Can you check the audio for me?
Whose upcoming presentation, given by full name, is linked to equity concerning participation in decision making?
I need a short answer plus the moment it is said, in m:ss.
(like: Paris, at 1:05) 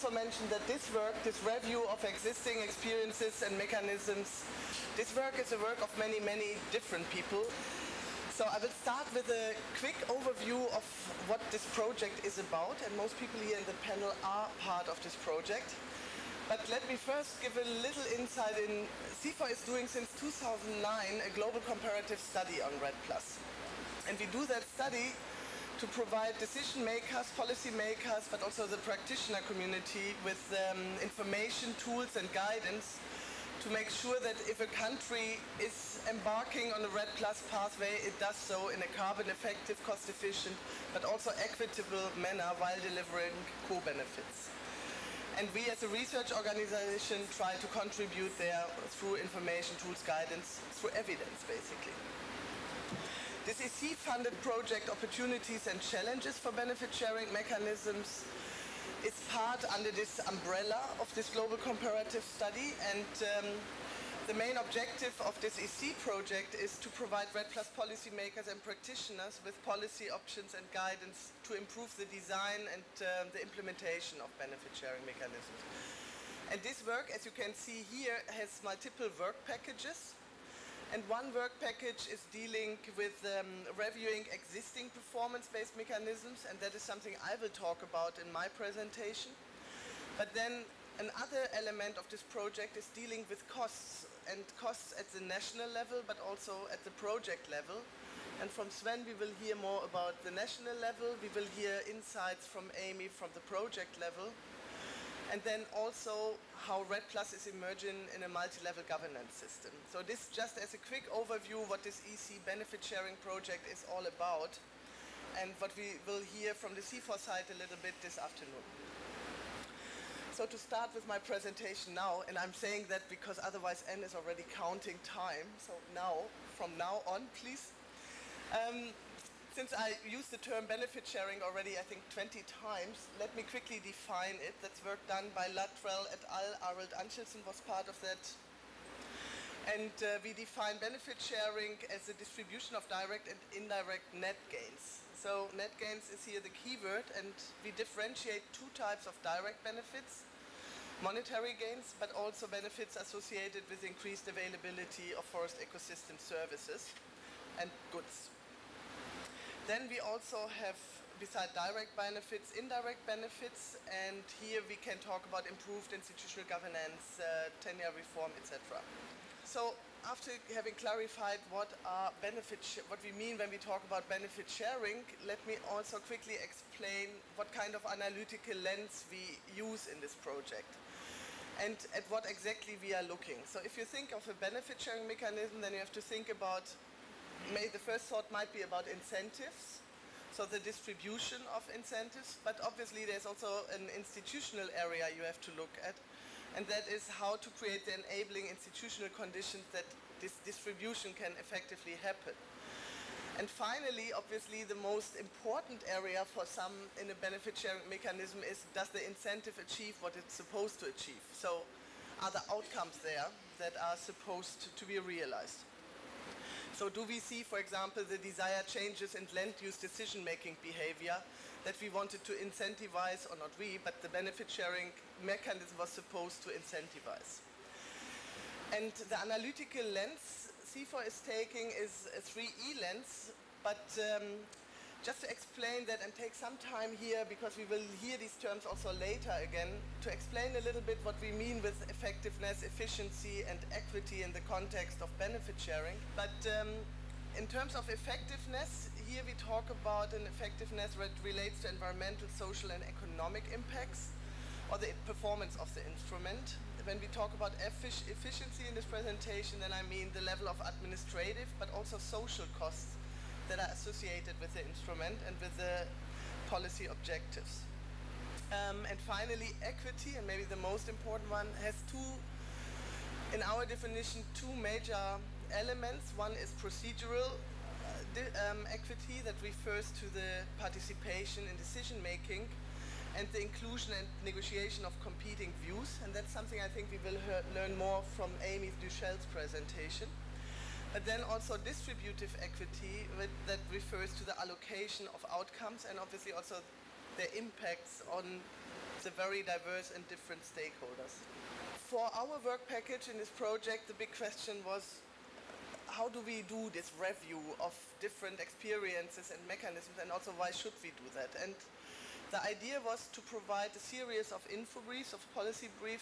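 Amy Duchelle, at 4:48.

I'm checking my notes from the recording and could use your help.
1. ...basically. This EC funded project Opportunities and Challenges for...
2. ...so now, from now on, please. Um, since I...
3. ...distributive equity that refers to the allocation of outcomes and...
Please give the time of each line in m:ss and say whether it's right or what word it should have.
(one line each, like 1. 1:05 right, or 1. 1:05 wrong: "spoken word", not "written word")
1. 0:51 right
2. 2:05 right
3. 4:51 right.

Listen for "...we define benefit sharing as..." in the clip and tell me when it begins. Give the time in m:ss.
2:20.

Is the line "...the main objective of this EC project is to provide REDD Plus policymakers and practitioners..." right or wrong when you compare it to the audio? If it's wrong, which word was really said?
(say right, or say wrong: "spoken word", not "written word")
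right.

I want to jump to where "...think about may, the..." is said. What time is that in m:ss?
3:06.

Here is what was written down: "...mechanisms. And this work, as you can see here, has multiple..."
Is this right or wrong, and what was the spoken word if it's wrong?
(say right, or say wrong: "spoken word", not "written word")
right.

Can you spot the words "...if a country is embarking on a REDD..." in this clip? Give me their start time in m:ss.
0:34.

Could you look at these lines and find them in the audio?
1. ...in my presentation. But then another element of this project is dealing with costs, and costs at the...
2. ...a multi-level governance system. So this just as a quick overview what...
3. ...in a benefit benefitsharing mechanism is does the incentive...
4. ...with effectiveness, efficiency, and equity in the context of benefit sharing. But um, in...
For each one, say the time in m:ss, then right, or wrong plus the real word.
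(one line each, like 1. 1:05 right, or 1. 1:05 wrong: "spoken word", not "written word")
1. 1:28 right
2. 1:48 right
3. 3:27 wrong: "sharing", not "benefitsharing"
4. 4:01 right.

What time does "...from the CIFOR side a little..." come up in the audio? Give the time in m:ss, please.
1:56.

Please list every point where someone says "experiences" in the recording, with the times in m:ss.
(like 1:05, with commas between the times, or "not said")
0:02, 5:08.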